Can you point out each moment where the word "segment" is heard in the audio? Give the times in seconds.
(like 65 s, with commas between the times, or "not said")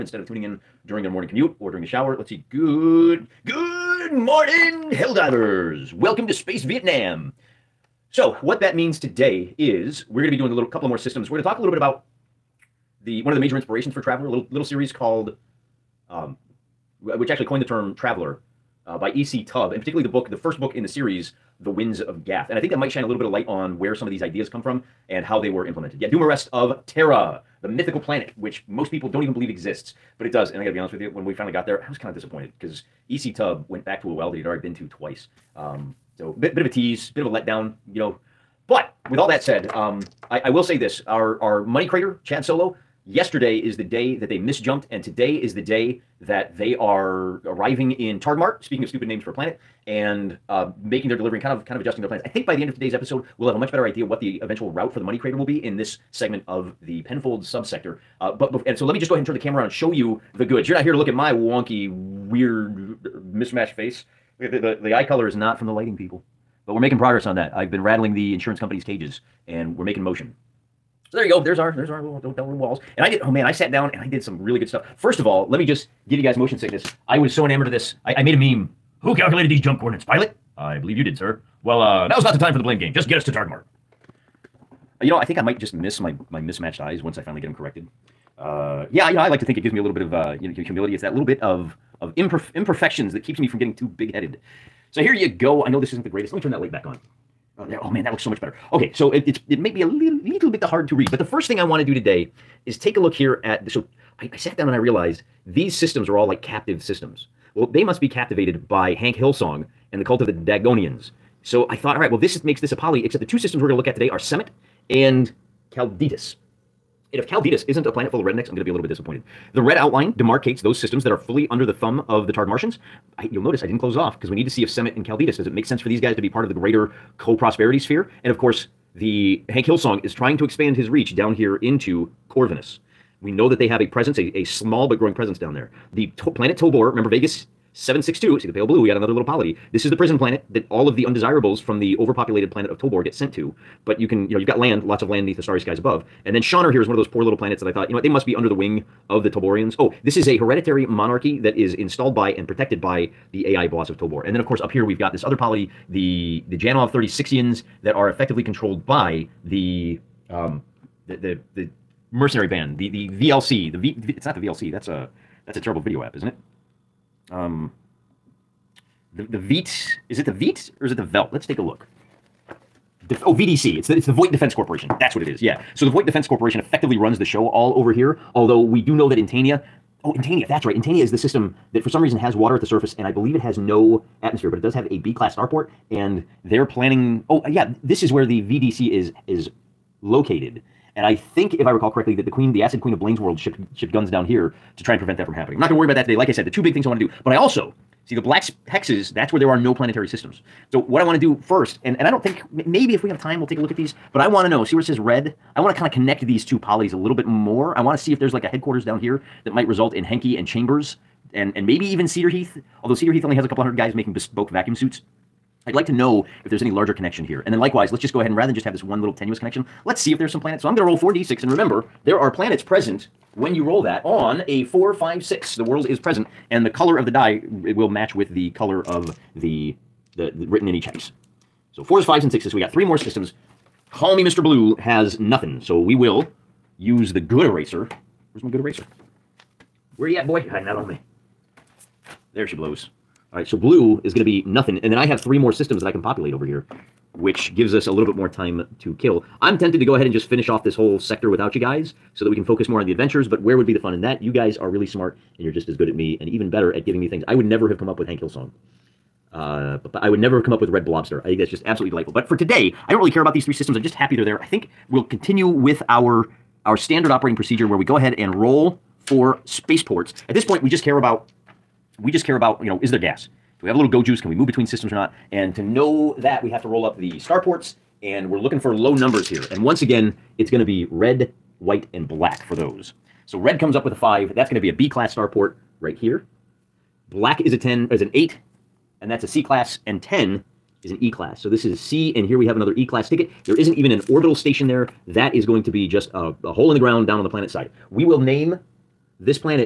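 56 s.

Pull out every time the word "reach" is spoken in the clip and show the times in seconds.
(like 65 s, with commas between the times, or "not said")
130 s.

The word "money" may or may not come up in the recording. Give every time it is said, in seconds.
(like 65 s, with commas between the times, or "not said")
41 s, 55 s.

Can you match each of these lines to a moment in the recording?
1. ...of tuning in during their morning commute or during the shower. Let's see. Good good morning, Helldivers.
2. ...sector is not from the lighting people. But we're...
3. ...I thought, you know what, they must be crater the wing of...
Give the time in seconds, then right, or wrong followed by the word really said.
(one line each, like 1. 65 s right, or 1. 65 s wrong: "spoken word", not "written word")
1. 0 s right
2. 65 s wrong: "color", not "sector"
3. 147 s wrong: "under", not "crater".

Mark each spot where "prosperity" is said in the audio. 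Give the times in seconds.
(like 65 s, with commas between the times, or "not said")
127 s.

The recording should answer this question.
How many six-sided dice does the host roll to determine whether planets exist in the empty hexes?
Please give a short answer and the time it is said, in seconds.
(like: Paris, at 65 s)
4d6, at 220 s.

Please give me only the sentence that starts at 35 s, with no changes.
Um, so bit bit of a tease, bit of a letdown, you know.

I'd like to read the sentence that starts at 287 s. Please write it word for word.
Black is a 10, is an 8, and that's a C class, and 10 is an E class.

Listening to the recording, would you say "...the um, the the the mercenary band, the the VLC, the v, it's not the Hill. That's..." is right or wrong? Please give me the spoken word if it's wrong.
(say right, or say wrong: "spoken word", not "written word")
wrong: "VLC", not "Hill".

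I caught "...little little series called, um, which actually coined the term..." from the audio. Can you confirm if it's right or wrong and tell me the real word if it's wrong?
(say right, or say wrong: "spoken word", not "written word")
right.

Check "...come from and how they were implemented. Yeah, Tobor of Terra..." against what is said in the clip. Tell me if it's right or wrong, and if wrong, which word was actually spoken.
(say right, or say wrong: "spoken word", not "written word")
wrong: "Dumarest", not "Tobor".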